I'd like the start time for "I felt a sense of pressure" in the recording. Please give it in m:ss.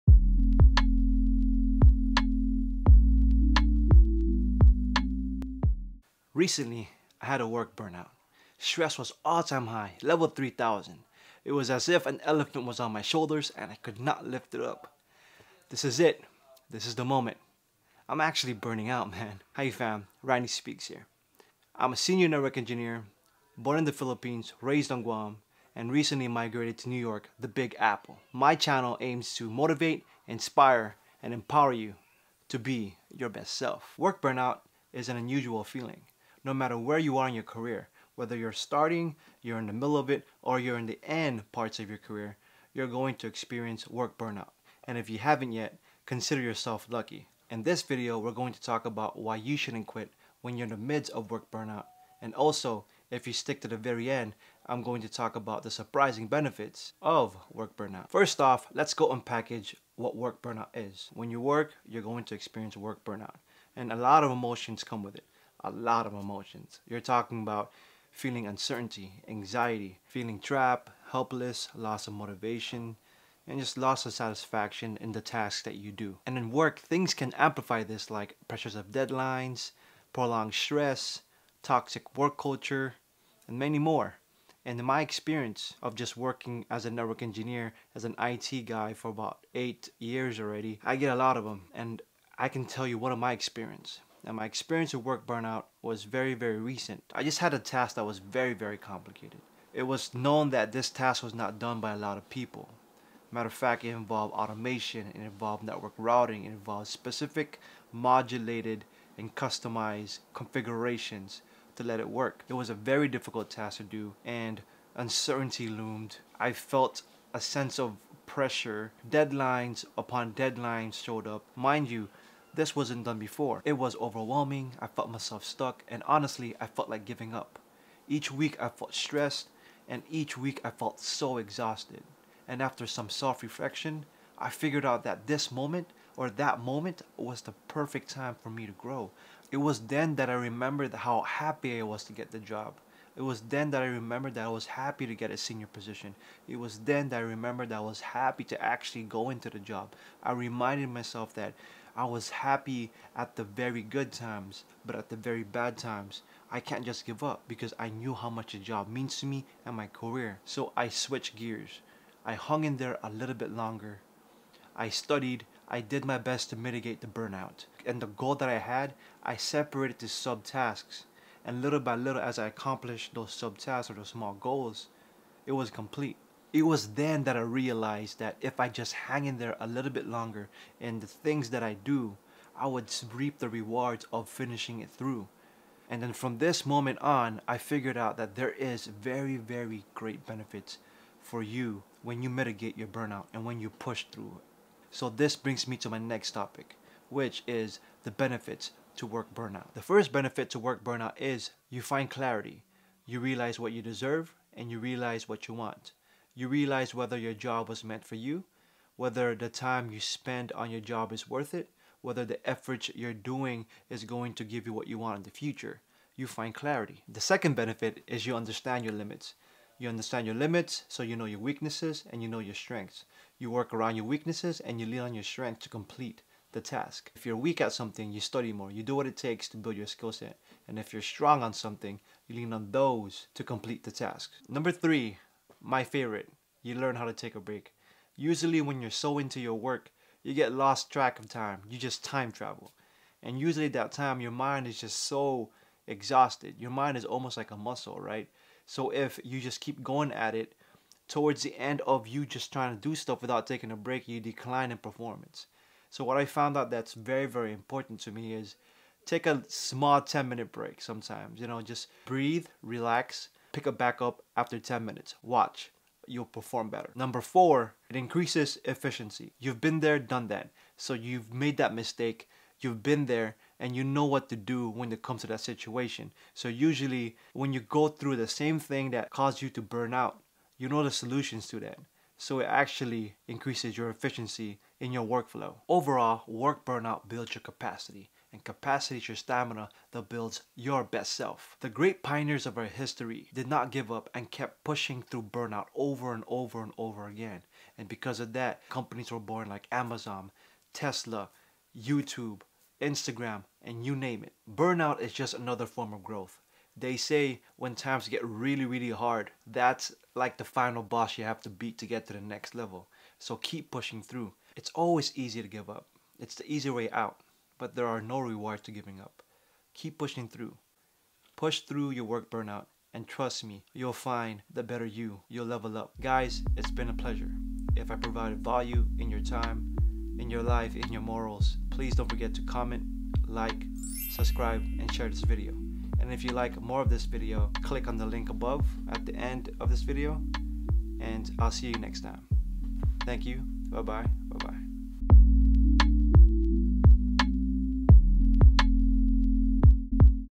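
1:56.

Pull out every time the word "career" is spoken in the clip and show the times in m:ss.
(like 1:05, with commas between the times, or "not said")
0:37, 0:41, 2:39.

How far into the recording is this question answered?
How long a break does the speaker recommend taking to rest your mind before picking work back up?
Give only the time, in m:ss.
4:20.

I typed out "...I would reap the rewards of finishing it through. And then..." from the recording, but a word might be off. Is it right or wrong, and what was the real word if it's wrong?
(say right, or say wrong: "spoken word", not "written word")
right.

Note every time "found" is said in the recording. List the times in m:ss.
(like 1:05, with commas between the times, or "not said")
4:16.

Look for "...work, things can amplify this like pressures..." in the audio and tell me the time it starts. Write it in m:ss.
1:16.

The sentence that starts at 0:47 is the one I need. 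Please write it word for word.
In this video, we're going to talk about why you shouldn't quit when you're in the midst of work burnout.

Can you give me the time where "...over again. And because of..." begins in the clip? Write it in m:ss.
4:56.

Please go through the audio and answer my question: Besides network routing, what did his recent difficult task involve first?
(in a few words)
Automation.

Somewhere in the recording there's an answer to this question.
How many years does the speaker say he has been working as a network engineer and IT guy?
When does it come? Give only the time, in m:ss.
1:29.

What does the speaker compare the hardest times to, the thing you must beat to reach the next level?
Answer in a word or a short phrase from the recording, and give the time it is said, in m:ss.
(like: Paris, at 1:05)
The final boss, at 5:10.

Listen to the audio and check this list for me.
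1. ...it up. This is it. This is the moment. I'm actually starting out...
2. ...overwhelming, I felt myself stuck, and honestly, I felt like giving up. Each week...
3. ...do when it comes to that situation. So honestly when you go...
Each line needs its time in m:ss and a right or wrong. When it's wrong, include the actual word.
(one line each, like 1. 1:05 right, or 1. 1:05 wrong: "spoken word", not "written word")
1. 0:14 wrong: "burning", not "starting"
2. 2:03 right
3. 4:34 wrong: "usually", not "honestly".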